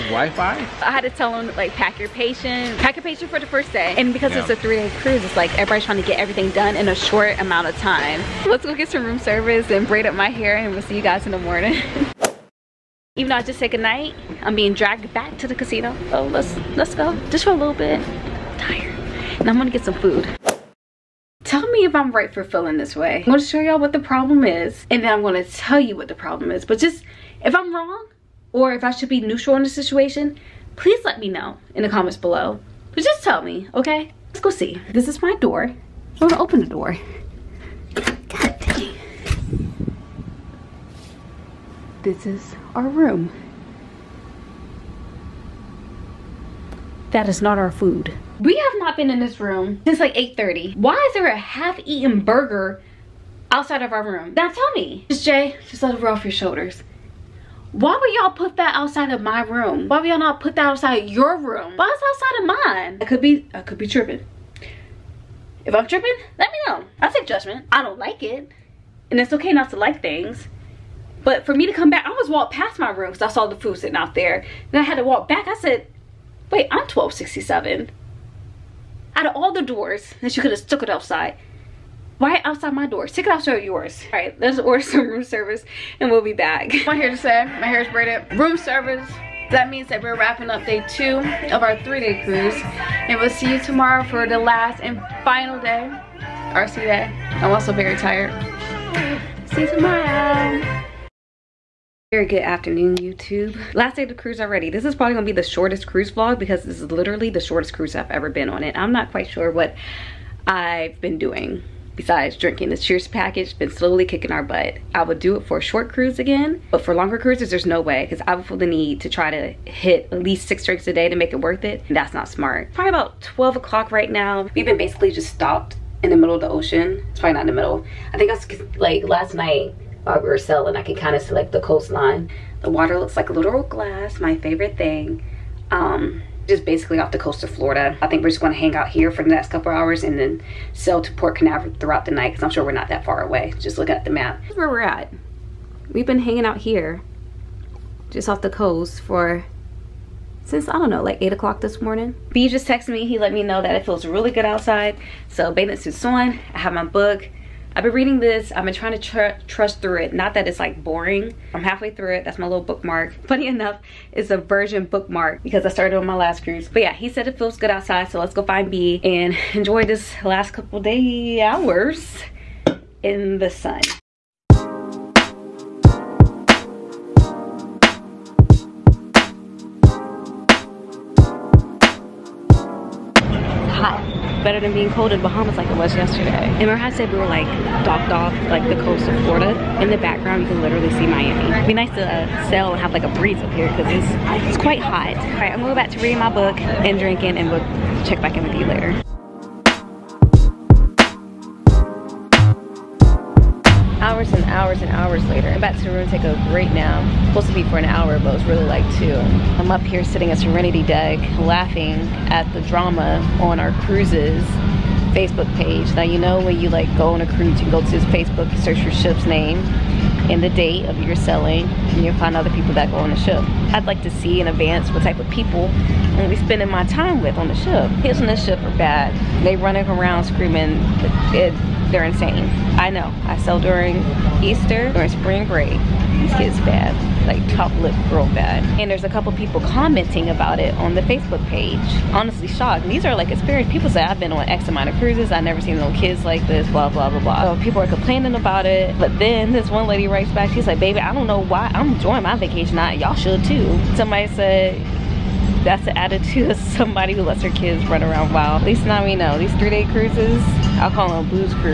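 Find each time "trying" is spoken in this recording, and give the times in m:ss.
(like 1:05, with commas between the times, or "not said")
0:05, 2:38.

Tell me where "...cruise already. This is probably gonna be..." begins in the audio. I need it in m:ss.
1:44.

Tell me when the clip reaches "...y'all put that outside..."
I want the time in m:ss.
0:58.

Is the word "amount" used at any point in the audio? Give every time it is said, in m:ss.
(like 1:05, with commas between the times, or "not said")
0:07, 4:04.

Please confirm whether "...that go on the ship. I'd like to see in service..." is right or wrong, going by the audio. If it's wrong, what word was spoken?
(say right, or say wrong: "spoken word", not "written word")
wrong: "advance", not "service".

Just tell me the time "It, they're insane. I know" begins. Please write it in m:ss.
3:51.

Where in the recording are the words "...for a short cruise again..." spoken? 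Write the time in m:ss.
1:55.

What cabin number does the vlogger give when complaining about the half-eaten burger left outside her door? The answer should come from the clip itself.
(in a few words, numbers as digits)
1267.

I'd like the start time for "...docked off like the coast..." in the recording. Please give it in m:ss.
3:07.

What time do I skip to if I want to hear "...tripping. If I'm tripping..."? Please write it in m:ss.
1:03.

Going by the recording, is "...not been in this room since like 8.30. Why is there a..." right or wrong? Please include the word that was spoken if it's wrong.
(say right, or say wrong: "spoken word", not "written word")
right.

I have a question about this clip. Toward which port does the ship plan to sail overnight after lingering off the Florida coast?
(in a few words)
Port Canaveral.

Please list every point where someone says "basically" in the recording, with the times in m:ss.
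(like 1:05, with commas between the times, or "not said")
2:04, 2:16.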